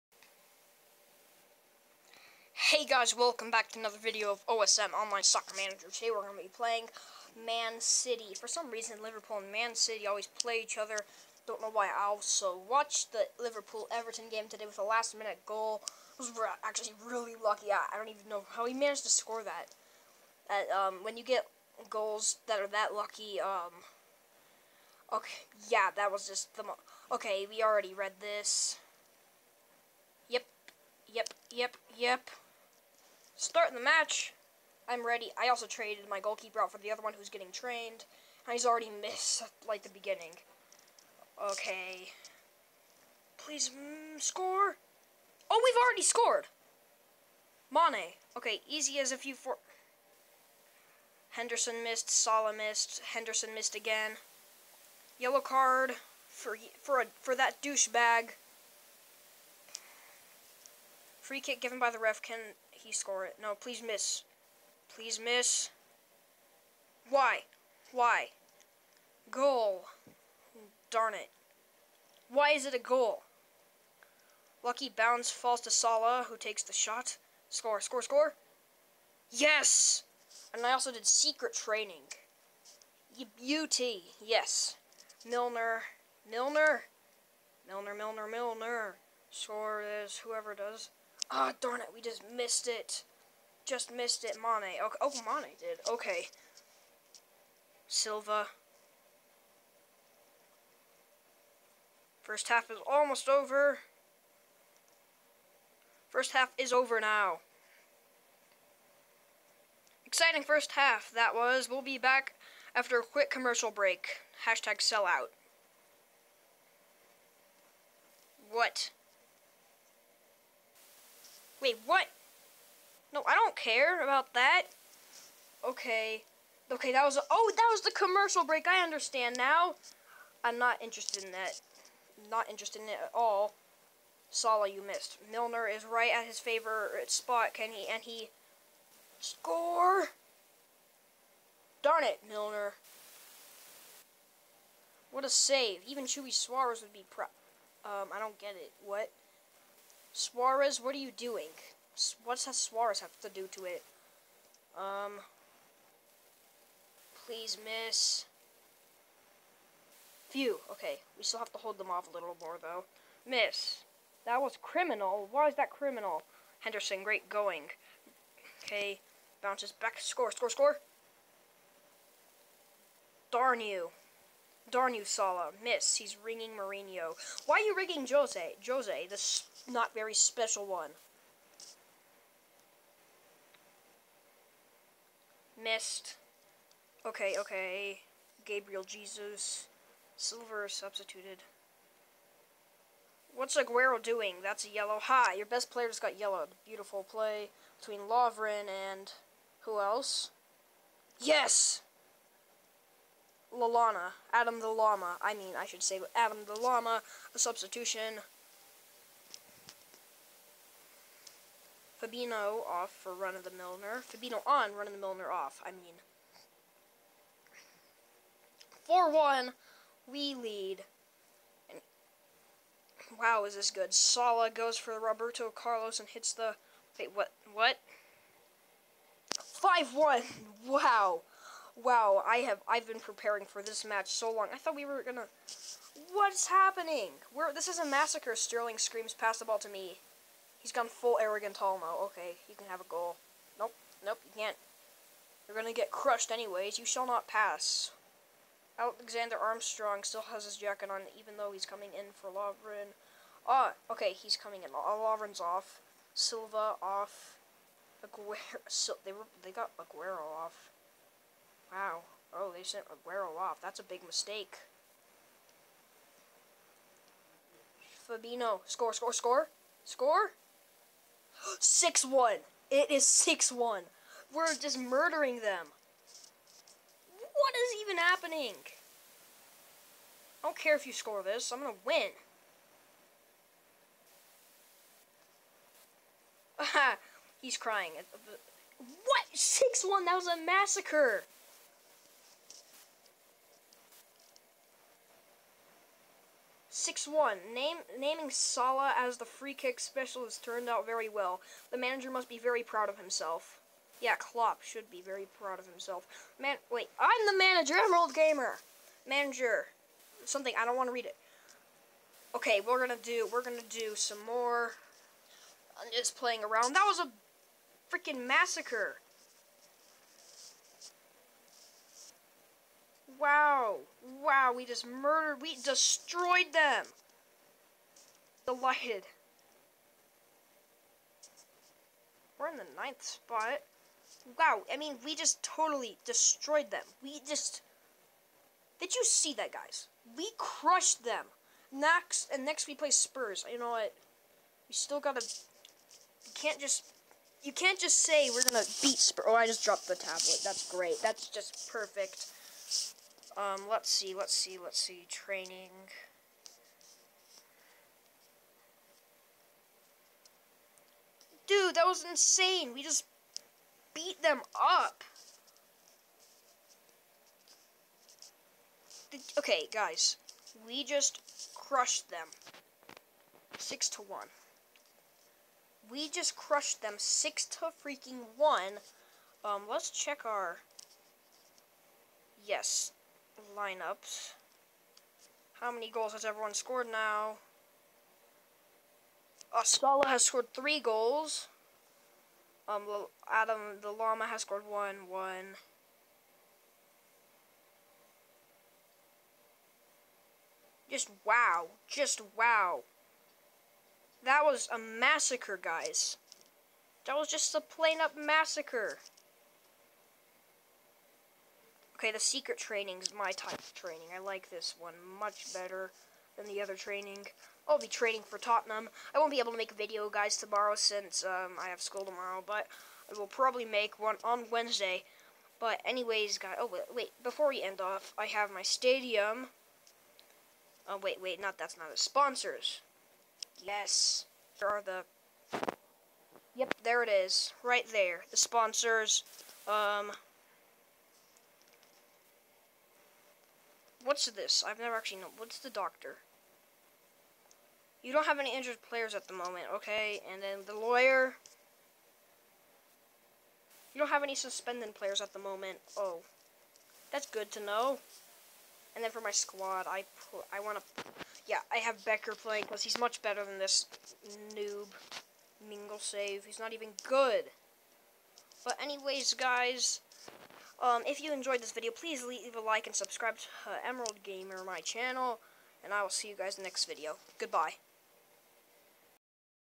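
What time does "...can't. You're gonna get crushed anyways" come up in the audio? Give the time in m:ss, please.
4:04.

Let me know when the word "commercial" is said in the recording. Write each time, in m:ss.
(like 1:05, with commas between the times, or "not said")
1:53, 2:07.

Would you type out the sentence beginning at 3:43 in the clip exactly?
Salah goes for Roberto Carlos and hits the...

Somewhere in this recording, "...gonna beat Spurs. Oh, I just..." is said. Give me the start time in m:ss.
5:48.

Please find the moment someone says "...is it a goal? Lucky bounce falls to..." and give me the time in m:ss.
1:12.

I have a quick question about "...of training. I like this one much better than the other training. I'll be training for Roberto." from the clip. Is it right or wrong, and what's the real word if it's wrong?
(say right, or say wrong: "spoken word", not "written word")
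wrong: "Tottenham", not "Roberto".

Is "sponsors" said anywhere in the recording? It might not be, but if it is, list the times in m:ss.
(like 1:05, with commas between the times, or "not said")
7:11, 7:18.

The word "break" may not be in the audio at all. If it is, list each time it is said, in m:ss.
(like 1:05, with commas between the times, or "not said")
1:53, 2:08.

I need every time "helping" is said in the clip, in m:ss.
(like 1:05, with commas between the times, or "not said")
not said.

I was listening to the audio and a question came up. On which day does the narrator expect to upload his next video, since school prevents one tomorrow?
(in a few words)
Wednesday.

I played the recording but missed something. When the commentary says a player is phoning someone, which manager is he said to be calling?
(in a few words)
Mourinho.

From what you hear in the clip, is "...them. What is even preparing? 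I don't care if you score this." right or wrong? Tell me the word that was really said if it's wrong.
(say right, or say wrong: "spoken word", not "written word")
wrong: "happening", not "preparing".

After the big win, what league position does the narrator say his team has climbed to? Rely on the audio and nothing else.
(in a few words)
9th.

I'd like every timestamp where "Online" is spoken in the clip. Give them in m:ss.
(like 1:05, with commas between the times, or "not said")
0:04.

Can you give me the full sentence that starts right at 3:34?
Fabinho on, Run of the Milner off, I mean.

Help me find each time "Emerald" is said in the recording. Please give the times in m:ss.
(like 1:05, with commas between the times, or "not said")
5:07, 7:53.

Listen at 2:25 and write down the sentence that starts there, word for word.
Even Chewy Suarez would be pro.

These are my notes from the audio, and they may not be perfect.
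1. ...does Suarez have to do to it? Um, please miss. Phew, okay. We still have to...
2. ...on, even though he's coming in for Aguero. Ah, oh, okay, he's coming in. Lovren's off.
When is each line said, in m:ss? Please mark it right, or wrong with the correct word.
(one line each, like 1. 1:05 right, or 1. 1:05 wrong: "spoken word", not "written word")
1. 2:32 right
2. 4:10 wrong: "Lovren", not "Aguero".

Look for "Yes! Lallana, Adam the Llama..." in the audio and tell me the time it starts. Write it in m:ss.
3:21.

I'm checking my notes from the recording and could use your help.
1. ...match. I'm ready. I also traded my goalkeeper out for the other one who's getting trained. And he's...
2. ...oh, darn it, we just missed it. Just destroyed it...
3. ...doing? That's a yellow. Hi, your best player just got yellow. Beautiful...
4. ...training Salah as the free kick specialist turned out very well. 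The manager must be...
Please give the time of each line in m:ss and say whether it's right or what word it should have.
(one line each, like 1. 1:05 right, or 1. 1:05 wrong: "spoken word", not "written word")
1. 0:33 right
2. 1:31 wrong: "missed", not "destroyed"
3. 3:14 right
4. 4:57 wrong: "naming", not "training".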